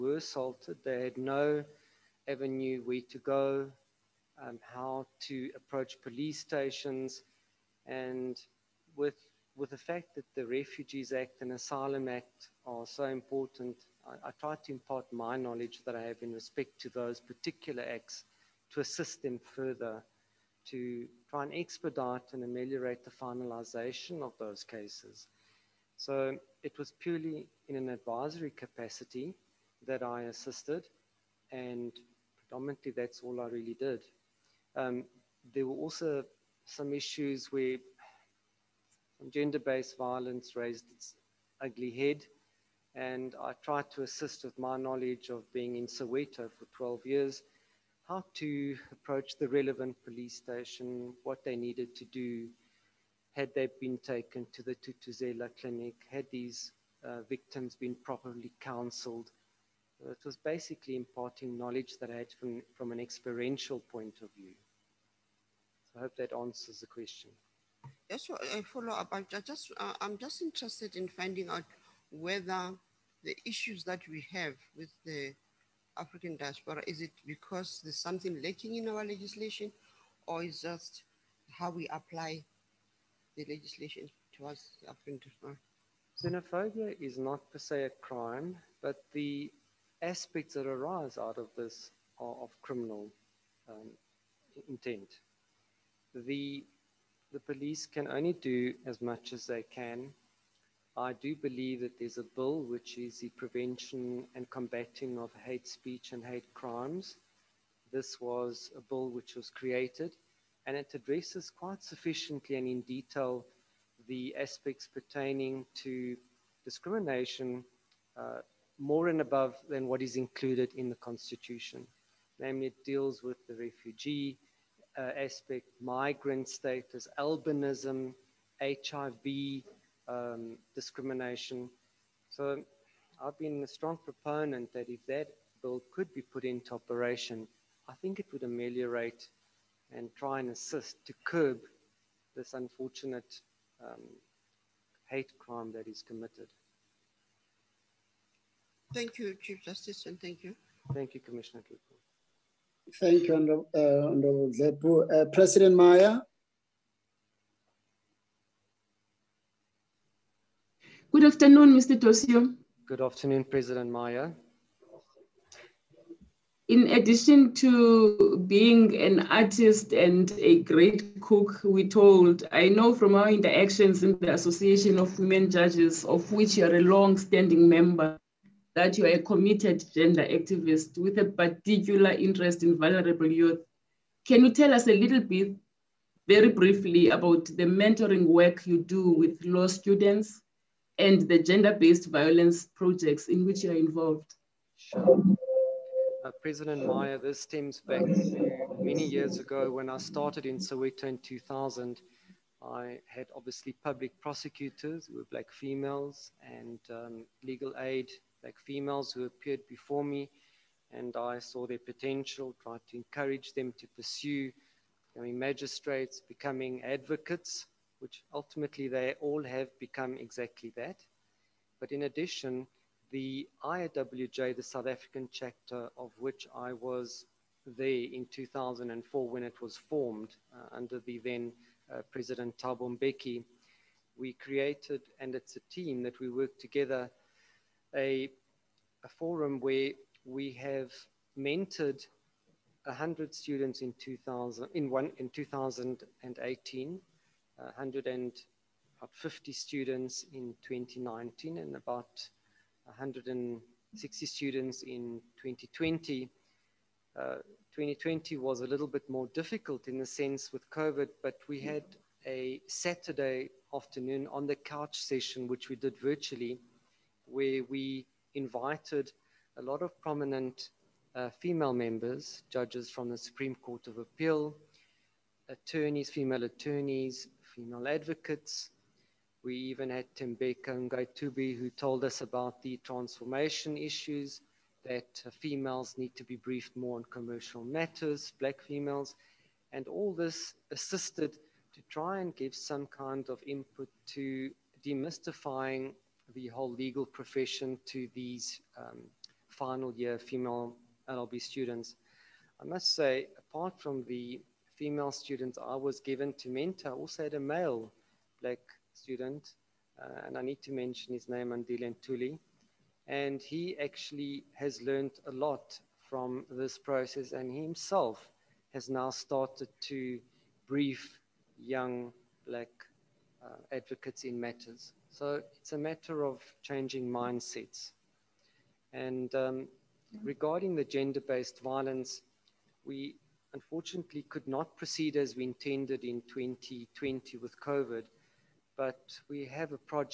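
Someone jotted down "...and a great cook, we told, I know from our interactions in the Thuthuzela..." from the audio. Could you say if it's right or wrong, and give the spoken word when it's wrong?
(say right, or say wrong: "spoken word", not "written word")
wrong: "Association", not "Thuthuzela".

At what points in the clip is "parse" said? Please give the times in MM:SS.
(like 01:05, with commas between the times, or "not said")
not said.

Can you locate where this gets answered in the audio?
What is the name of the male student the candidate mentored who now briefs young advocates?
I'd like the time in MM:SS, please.
05:11.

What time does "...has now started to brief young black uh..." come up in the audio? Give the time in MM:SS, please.
05:18.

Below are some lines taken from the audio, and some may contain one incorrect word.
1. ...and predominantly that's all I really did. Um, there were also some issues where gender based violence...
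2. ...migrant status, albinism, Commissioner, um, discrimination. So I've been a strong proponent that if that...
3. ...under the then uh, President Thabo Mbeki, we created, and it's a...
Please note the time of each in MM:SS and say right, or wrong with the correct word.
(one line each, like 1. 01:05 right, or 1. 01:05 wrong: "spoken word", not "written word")
1. 00:31 right
2. 02:05 wrong: "HIV", not "Commissioner"
3. 03:50 right.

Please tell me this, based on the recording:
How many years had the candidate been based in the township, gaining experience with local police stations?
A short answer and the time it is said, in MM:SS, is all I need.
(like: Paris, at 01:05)
12, at 00:46.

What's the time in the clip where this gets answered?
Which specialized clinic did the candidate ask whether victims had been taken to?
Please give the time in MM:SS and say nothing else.
00:54.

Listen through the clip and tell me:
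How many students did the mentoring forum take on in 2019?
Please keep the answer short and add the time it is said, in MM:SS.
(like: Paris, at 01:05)
150, at 04:07.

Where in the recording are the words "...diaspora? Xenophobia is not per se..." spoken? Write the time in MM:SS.
01:25.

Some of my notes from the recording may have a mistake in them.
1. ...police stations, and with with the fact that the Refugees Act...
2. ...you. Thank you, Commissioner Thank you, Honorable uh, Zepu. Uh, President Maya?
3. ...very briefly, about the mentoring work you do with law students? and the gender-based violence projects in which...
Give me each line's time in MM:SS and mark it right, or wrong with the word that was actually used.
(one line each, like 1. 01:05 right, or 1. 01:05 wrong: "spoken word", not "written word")
1. 00:06 right
2. 02:30 right
3. 03:06 right.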